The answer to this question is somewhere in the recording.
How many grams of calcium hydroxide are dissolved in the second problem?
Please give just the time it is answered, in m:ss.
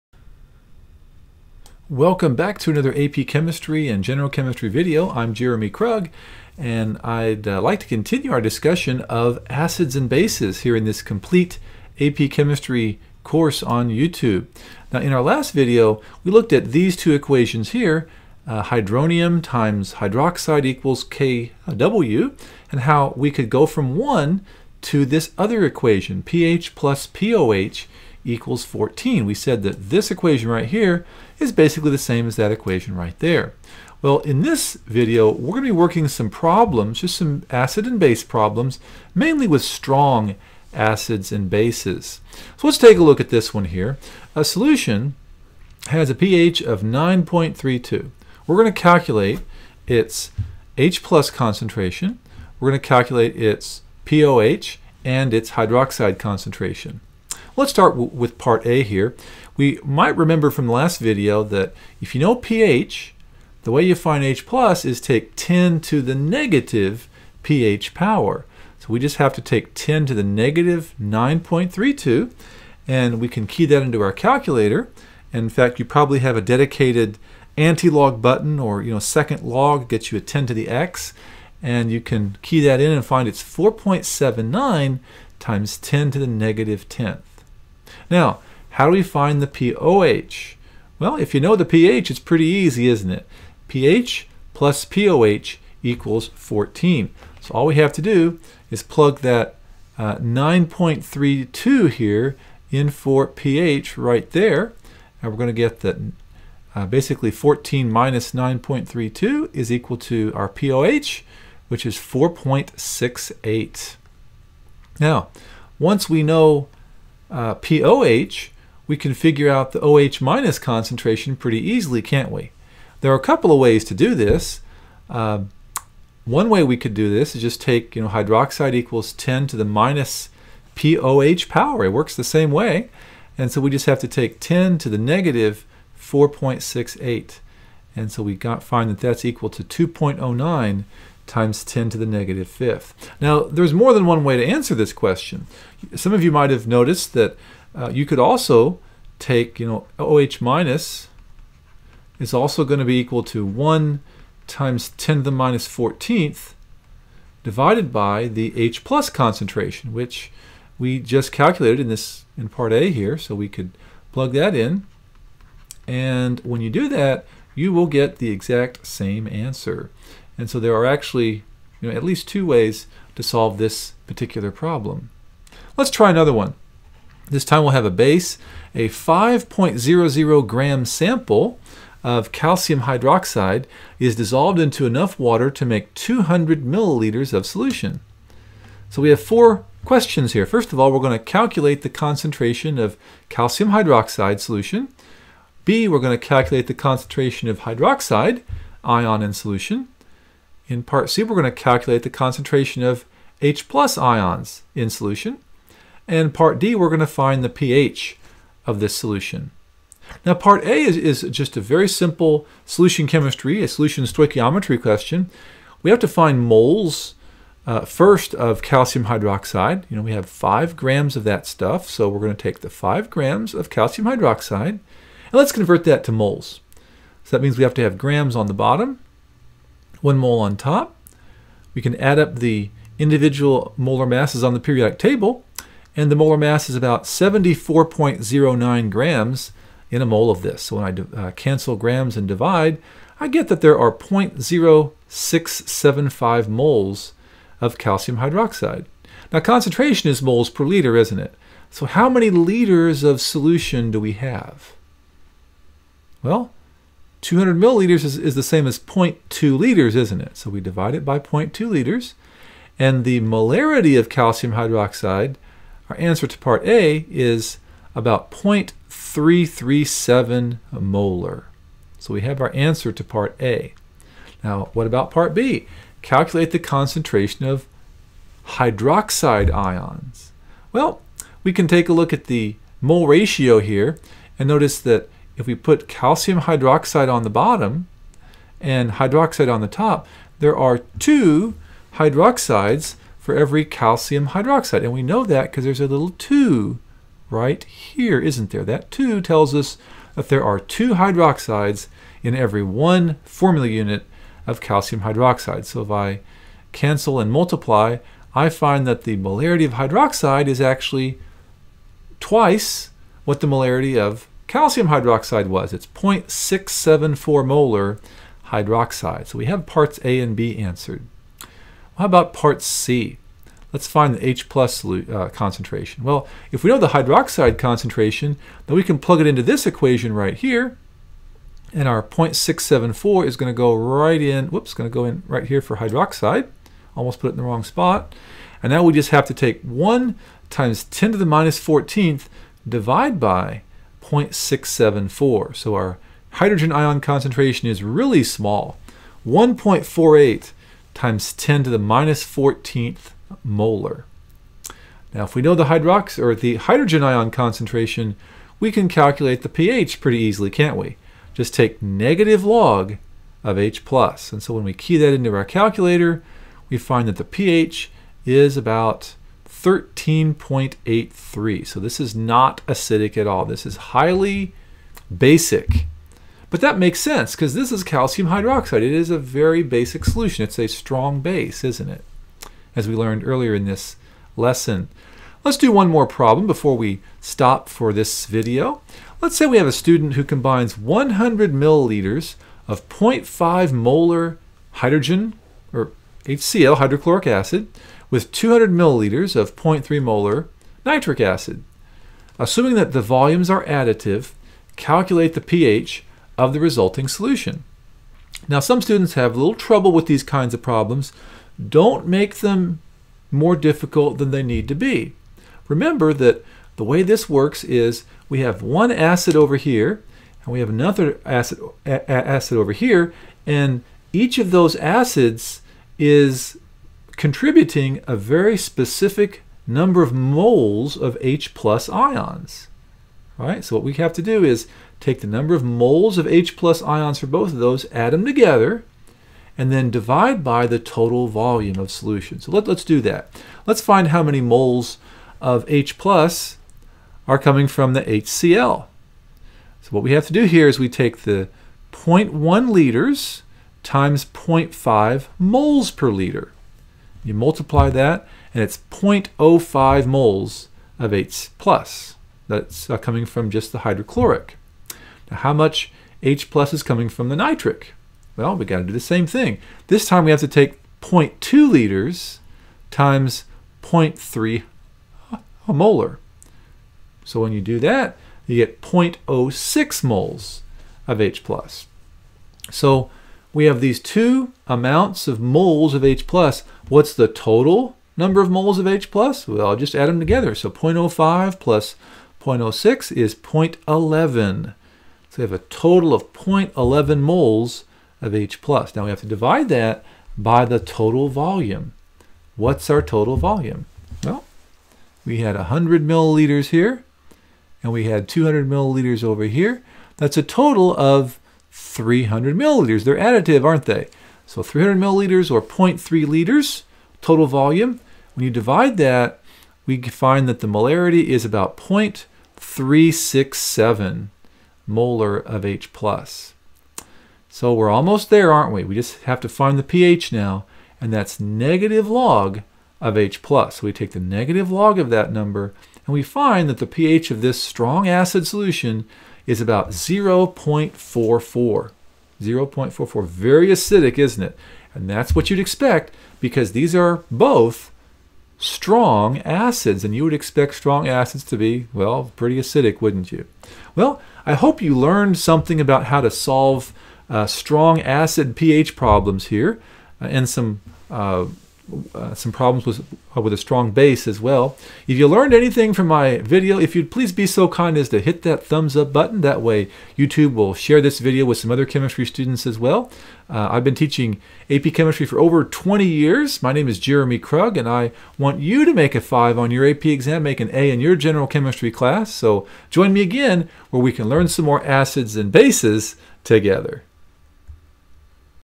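2:58.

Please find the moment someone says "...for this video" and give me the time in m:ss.
6:27.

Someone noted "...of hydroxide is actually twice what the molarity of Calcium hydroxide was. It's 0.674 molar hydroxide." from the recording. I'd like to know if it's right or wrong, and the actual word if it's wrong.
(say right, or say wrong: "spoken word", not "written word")
right.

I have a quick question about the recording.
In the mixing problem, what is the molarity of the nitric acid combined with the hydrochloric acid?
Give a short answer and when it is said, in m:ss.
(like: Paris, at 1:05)
0.3 molar, at 6:39.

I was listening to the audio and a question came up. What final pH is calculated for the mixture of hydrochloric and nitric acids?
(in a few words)
0.44.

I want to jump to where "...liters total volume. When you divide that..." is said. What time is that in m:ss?
8:36.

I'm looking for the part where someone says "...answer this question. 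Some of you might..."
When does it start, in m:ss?
2:24.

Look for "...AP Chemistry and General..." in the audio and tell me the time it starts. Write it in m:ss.
0:02.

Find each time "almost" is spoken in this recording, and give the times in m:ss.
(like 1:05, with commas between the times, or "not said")
5:36, 8:47.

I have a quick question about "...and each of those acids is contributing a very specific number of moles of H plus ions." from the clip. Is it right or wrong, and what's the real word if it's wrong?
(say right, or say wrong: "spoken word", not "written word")
right.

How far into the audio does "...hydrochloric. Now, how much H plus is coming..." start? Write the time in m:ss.
7:43.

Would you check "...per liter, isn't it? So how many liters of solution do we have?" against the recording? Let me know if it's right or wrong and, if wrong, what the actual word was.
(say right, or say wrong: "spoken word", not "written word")
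right.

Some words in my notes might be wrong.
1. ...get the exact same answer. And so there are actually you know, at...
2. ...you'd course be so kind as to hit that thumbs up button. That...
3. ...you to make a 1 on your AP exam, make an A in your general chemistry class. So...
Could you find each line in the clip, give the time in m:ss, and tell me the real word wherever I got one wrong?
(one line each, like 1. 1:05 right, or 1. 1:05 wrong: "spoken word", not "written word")
1. 2:47 right
2. 9:26 wrong: "please", not "course"
3. 9:38 wrong: "5", not "1".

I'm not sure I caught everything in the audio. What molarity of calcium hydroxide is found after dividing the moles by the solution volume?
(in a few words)
0.337 molar.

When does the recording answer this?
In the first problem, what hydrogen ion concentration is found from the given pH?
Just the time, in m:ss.
1:23.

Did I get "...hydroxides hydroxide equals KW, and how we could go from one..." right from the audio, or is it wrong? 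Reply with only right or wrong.
wrong.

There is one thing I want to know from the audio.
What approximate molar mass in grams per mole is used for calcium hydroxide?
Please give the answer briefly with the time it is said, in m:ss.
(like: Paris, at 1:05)
74.09, at 3:57.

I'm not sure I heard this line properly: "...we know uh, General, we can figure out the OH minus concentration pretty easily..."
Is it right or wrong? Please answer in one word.
wrong.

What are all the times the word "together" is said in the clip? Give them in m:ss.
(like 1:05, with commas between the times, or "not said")
7:18, 8:10, 9:46.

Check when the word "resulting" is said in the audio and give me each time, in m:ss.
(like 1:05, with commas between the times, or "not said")
6:46.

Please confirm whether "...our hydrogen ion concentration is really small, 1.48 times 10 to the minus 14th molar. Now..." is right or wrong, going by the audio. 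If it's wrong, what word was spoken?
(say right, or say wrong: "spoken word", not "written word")
right.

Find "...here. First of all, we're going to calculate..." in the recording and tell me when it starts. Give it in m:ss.
3:10.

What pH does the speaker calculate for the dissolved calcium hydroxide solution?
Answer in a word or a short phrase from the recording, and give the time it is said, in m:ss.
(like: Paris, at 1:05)
13.83, at 6:09.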